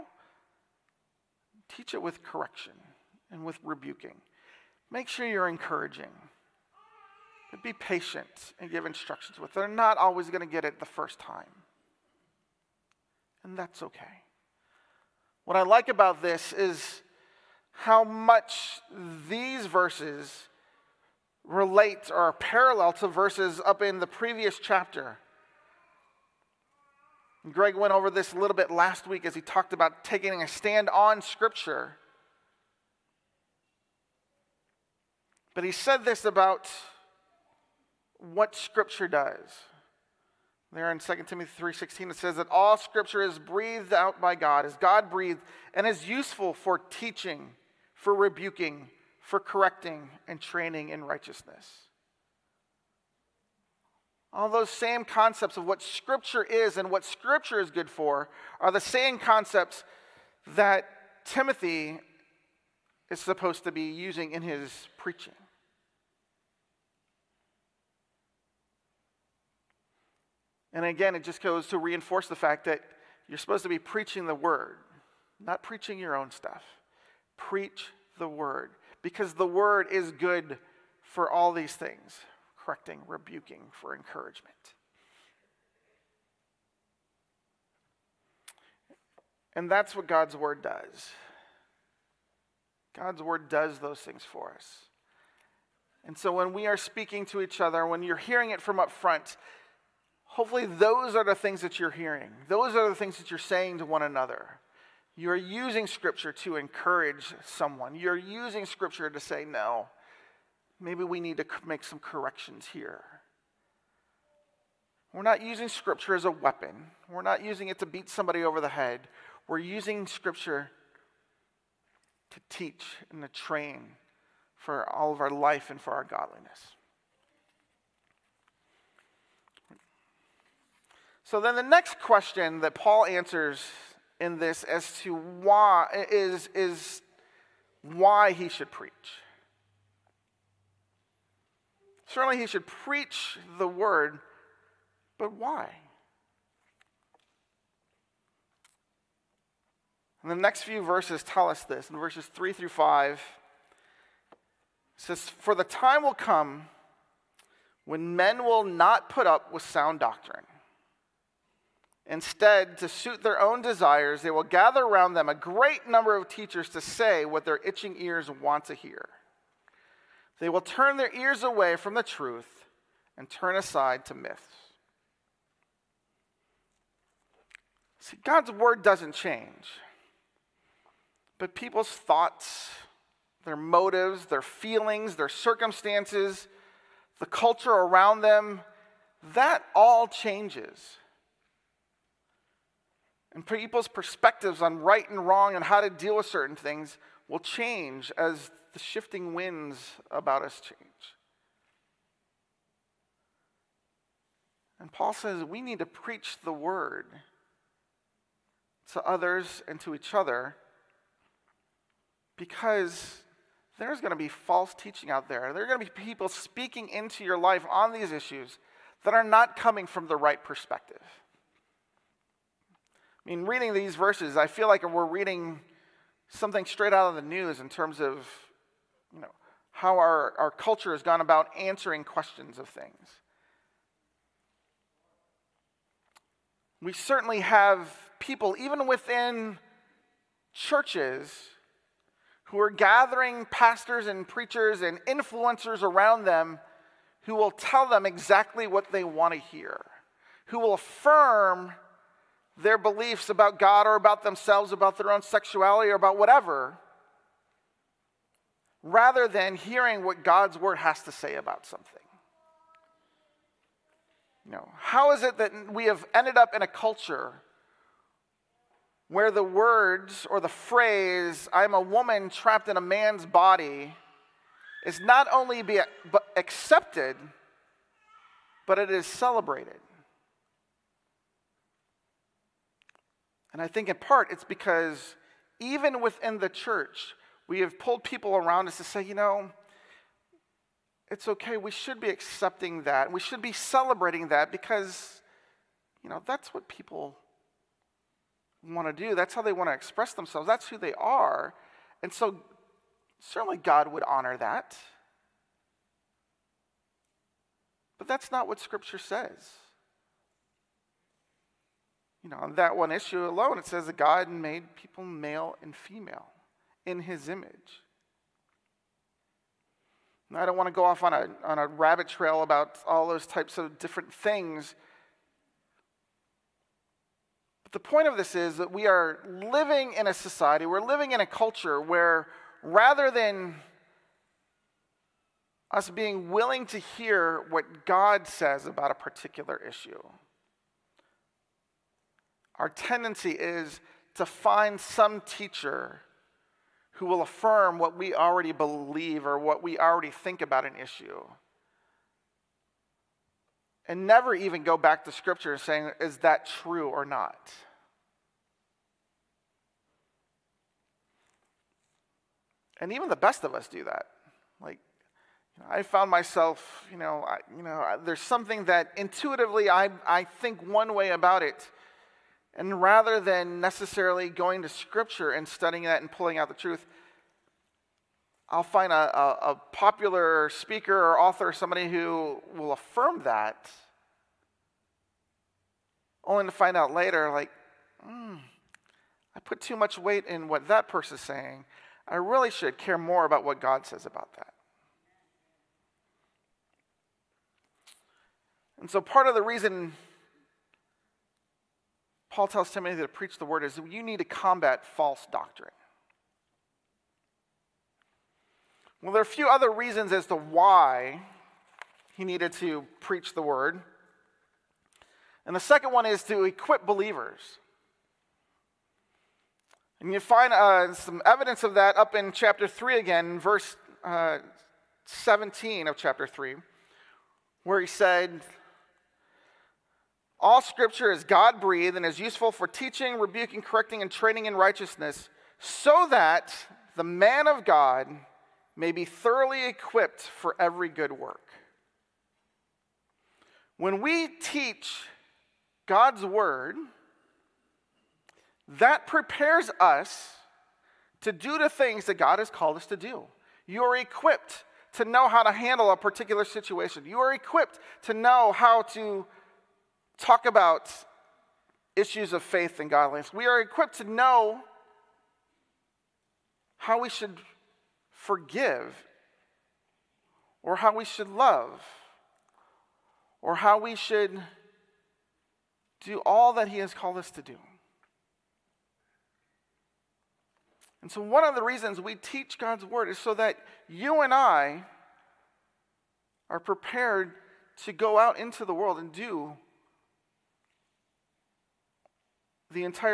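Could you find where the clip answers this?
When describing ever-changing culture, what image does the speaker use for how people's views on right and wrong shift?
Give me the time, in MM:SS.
03:18.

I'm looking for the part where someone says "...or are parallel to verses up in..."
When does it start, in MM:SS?
00:22.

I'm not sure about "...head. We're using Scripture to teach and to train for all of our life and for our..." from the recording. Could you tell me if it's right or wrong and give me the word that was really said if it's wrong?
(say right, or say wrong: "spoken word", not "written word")
right.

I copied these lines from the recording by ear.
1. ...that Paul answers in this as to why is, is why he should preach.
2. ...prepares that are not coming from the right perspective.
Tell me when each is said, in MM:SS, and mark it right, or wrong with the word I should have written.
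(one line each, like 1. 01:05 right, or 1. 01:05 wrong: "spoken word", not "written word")
1. 02:12 right
2. 03:38 wrong: "issues", not "prepares".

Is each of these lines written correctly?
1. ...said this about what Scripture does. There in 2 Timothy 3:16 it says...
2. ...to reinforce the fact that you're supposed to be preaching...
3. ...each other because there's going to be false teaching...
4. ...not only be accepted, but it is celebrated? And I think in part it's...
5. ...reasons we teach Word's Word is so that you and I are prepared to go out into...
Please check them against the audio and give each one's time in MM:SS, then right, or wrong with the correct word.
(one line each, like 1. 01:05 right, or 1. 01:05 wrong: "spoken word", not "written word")
1. 00:35 right
2. 01:11 right
3. 03:29 right
4. 04:35 right
5. 08:01 wrong: "God", not "Word".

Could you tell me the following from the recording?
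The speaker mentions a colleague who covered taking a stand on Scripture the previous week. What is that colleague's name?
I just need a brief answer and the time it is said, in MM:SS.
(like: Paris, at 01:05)
Greg, at 00:27.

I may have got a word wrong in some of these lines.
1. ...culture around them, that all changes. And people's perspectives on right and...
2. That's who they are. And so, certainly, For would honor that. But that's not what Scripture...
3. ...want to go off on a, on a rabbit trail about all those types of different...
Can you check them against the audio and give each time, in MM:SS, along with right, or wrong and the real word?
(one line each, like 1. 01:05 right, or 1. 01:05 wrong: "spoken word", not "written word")
1. 03:07 right
2. 05:00 wrong: "God", not "For"
3. 05:20 right.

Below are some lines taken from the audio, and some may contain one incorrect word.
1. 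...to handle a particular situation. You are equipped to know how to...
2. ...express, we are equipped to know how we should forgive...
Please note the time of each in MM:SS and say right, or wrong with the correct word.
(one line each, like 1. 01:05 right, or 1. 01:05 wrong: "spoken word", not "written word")
1. 07:35 right
2. 07:42 wrong: "godliness", not "express".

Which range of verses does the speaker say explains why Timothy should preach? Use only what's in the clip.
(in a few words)
3 through 5.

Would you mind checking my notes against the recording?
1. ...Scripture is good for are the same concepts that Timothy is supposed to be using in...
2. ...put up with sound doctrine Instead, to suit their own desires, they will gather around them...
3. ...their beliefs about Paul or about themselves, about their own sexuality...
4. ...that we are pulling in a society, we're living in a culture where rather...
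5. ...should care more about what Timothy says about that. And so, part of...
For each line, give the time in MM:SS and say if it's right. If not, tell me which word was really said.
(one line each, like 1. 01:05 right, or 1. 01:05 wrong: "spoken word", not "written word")
1. 00:57 right
2. 02:39 right
3. 04:12 wrong: "God", not "Paul"
4. 05:28 wrong: "living", not "pulling"
5. 06:32 wrong: "God", not "Timothy".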